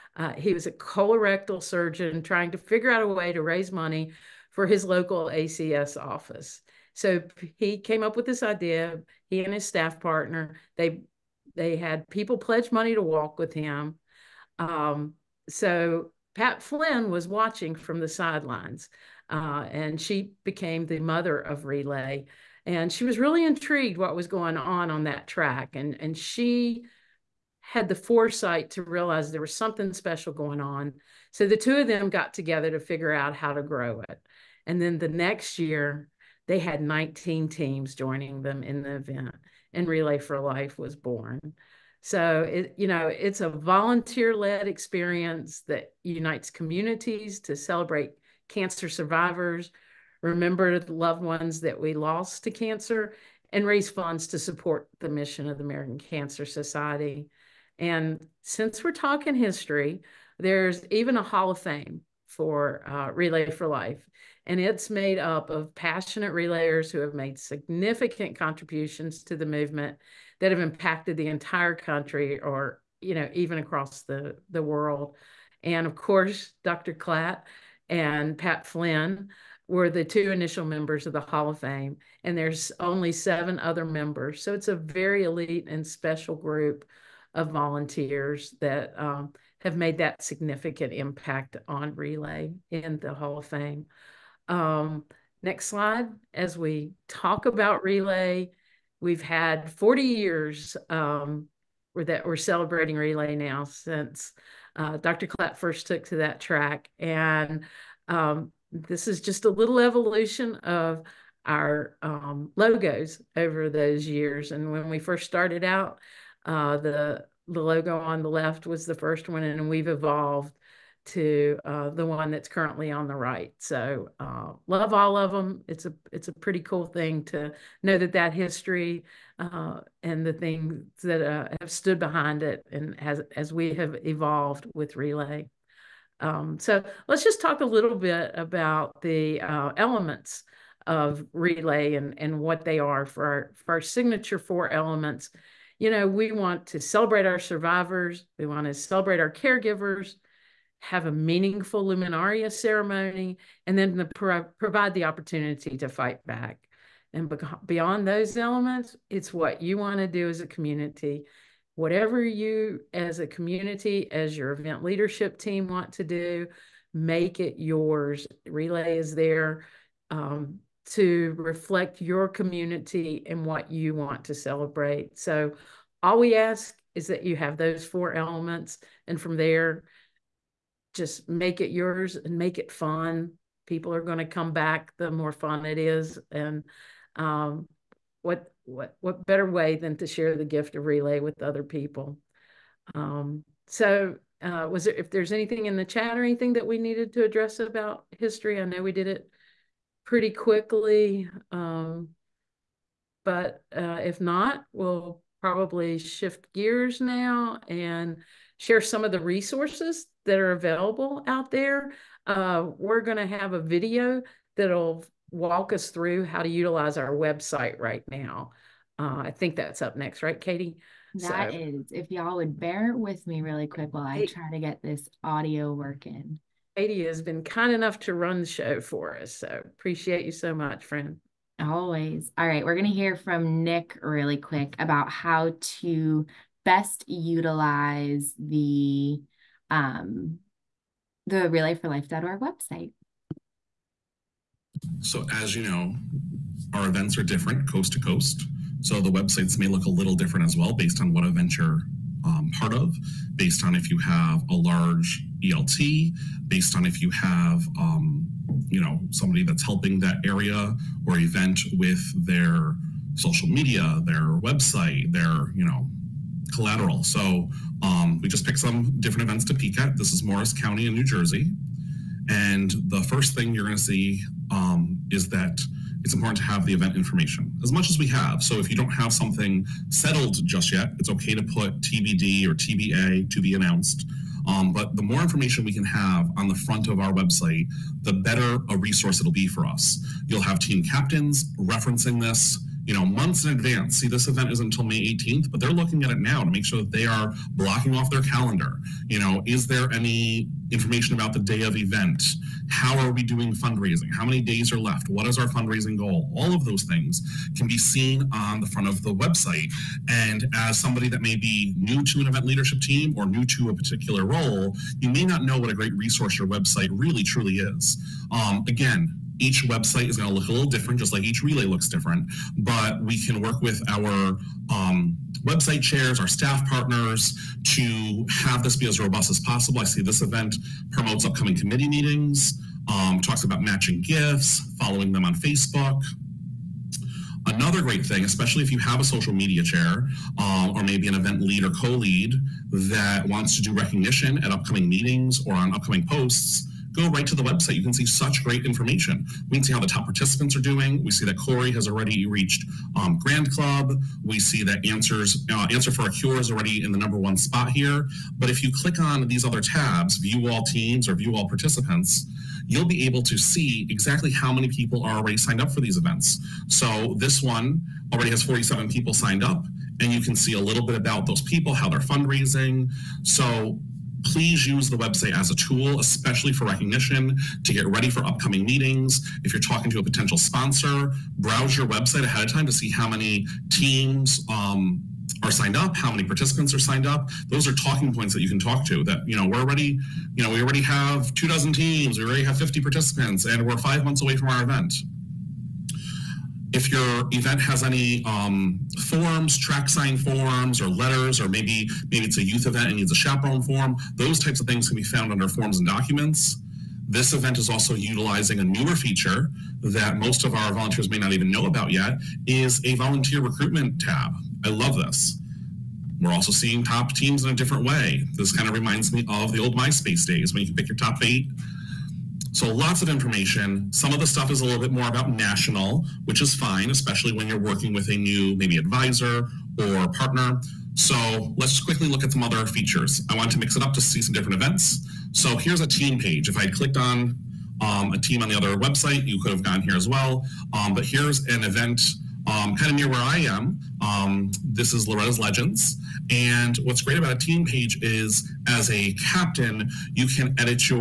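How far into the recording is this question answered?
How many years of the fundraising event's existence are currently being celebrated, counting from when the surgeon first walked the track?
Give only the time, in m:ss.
1:39.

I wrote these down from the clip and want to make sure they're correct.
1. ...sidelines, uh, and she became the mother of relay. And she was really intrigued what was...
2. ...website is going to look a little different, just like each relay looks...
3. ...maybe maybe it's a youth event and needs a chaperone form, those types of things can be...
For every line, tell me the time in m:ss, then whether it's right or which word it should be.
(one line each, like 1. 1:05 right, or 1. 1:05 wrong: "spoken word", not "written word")
1. 0:18 right
2. 5:19 right
3. 6:41 right.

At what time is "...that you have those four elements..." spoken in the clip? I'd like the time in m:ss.
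2:57.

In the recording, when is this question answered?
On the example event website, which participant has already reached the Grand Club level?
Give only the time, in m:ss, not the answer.
5:51.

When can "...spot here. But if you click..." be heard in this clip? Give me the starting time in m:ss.
5:57.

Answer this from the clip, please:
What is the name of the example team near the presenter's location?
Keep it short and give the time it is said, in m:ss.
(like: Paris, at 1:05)
Loretta's Legends, at 7:25.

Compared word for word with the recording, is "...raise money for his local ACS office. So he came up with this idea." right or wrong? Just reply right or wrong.
right.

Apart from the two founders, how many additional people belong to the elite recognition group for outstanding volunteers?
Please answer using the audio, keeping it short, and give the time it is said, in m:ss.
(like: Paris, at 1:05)
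7, at 1:23.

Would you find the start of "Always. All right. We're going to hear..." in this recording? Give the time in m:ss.
3:51.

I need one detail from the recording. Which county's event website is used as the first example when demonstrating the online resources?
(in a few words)
Morris County.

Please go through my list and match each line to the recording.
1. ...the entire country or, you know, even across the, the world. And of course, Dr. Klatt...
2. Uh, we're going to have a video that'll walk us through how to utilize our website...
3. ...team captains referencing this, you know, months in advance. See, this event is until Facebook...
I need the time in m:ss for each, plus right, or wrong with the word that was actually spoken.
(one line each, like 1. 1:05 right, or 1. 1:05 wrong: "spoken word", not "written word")
1. 1:11 right
2. 3:32 right
3. 4:50 wrong: "May", not "Facebook".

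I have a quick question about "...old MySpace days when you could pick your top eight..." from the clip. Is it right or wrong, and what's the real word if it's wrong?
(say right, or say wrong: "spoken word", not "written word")
right.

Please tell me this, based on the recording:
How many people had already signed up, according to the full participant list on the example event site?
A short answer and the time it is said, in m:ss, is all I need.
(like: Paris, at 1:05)
47, at 6:08.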